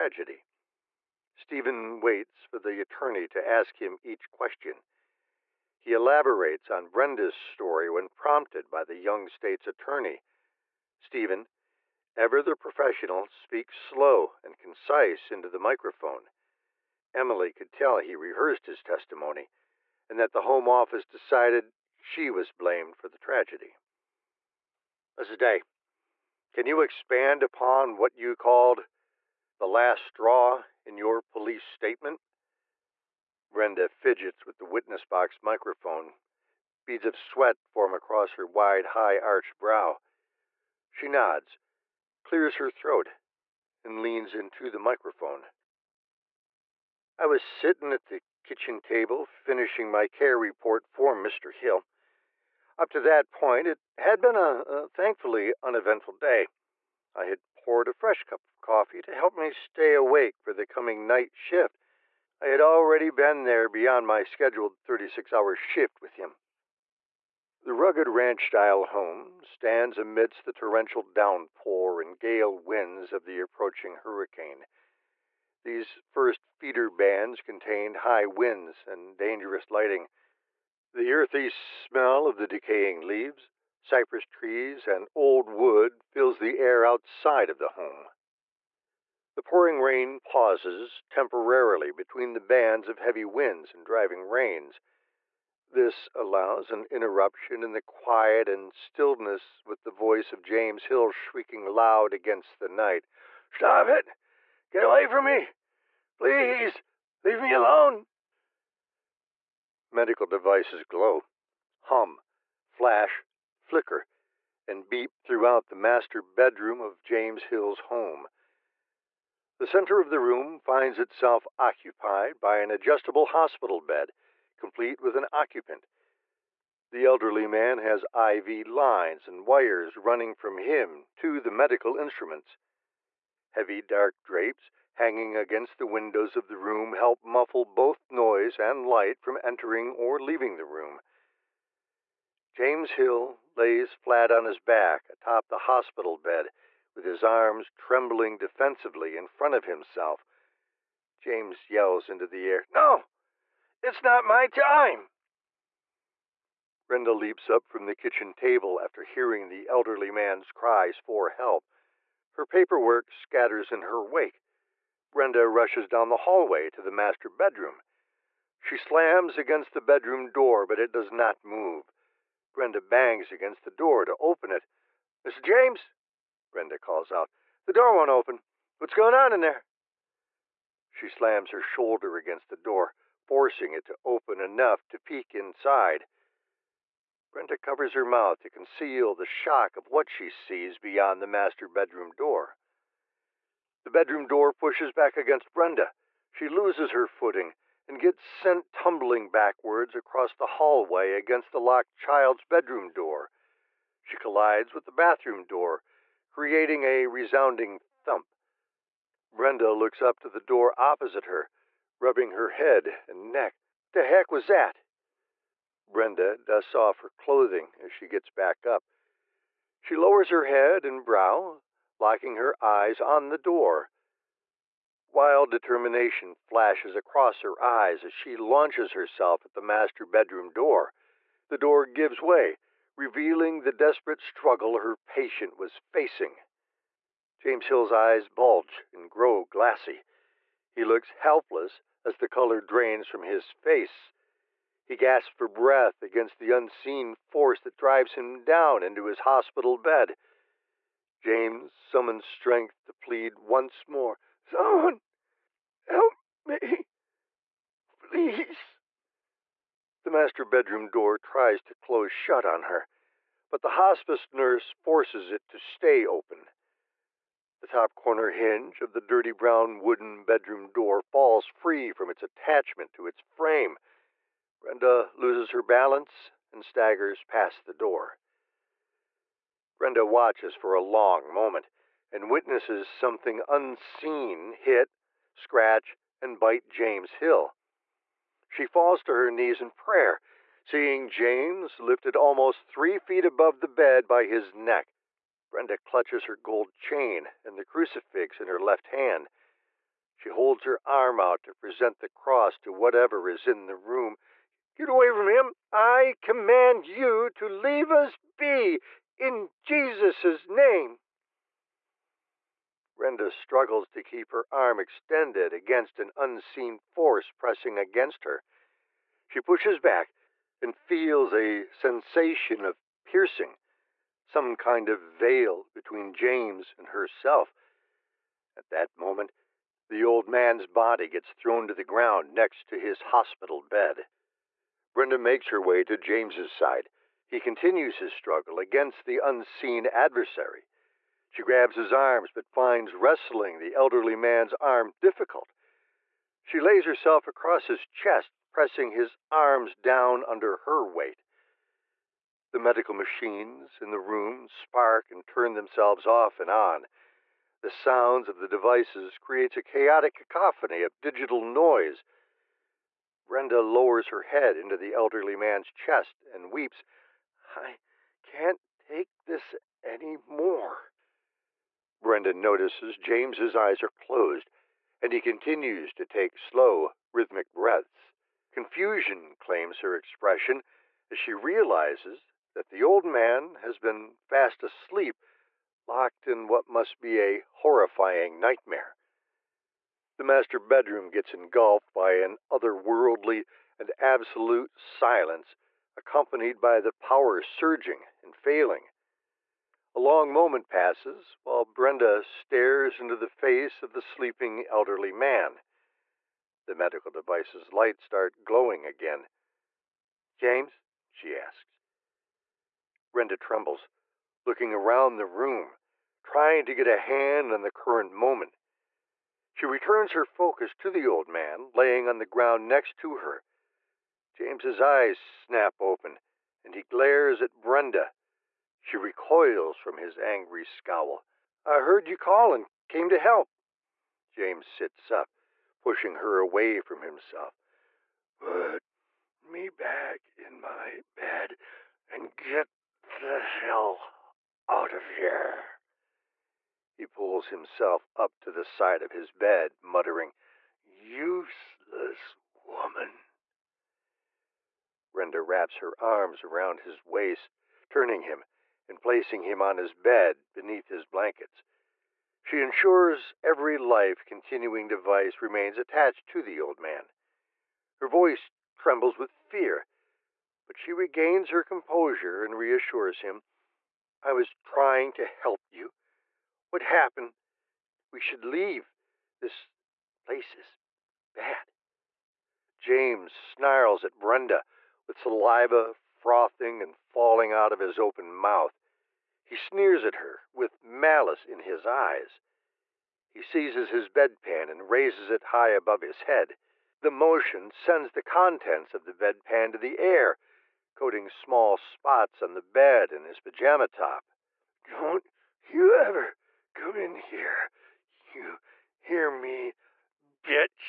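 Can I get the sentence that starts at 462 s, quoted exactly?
She ensures every life continuing device remains attached to the old man.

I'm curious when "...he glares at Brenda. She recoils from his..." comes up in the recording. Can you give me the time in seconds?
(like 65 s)
426 s.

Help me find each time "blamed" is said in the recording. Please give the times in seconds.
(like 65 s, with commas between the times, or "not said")
22 s.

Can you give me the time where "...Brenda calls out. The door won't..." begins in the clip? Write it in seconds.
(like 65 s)
176 s.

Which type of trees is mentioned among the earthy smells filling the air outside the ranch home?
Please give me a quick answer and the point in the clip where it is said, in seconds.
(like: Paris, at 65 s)
cypress, at 83 s.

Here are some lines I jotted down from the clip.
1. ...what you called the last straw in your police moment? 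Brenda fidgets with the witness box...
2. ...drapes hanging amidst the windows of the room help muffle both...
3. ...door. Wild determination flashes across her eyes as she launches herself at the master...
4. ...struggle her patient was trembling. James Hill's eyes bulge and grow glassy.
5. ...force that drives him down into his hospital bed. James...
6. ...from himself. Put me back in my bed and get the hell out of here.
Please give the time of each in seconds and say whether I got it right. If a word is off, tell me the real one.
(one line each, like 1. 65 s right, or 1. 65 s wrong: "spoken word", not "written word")
1. 27 s wrong: "statement", not "moment"
2. 134 s wrong: "against", not "amidst"
3. 223 s right
4. 234 s wrong: "facing", not "trembling"
5. 247 s right
6. 436 s right.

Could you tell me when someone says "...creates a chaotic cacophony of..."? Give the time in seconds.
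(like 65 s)
359 s.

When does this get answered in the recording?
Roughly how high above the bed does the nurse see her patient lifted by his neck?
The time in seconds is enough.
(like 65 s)
292 s.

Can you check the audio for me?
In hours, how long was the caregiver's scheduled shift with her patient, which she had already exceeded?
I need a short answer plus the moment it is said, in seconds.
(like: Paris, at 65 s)
36 hours, at 64 s.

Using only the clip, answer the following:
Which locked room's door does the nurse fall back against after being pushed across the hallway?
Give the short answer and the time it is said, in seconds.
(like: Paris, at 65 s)
child's bedroom, at 201 s.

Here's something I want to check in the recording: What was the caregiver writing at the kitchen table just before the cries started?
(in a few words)
care report.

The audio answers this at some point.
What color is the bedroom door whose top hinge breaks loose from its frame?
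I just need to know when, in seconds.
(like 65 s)
269 s.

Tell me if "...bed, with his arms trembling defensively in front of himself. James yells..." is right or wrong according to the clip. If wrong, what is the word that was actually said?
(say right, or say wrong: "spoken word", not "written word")
right.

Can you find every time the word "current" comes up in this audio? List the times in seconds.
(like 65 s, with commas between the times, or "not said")
417 s.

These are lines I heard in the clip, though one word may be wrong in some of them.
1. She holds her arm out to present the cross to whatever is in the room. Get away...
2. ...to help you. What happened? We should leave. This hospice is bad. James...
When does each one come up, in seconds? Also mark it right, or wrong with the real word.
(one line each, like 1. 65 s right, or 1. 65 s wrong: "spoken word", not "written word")
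1. 300 s right
2. 475 s wrong: "place", not "hospice".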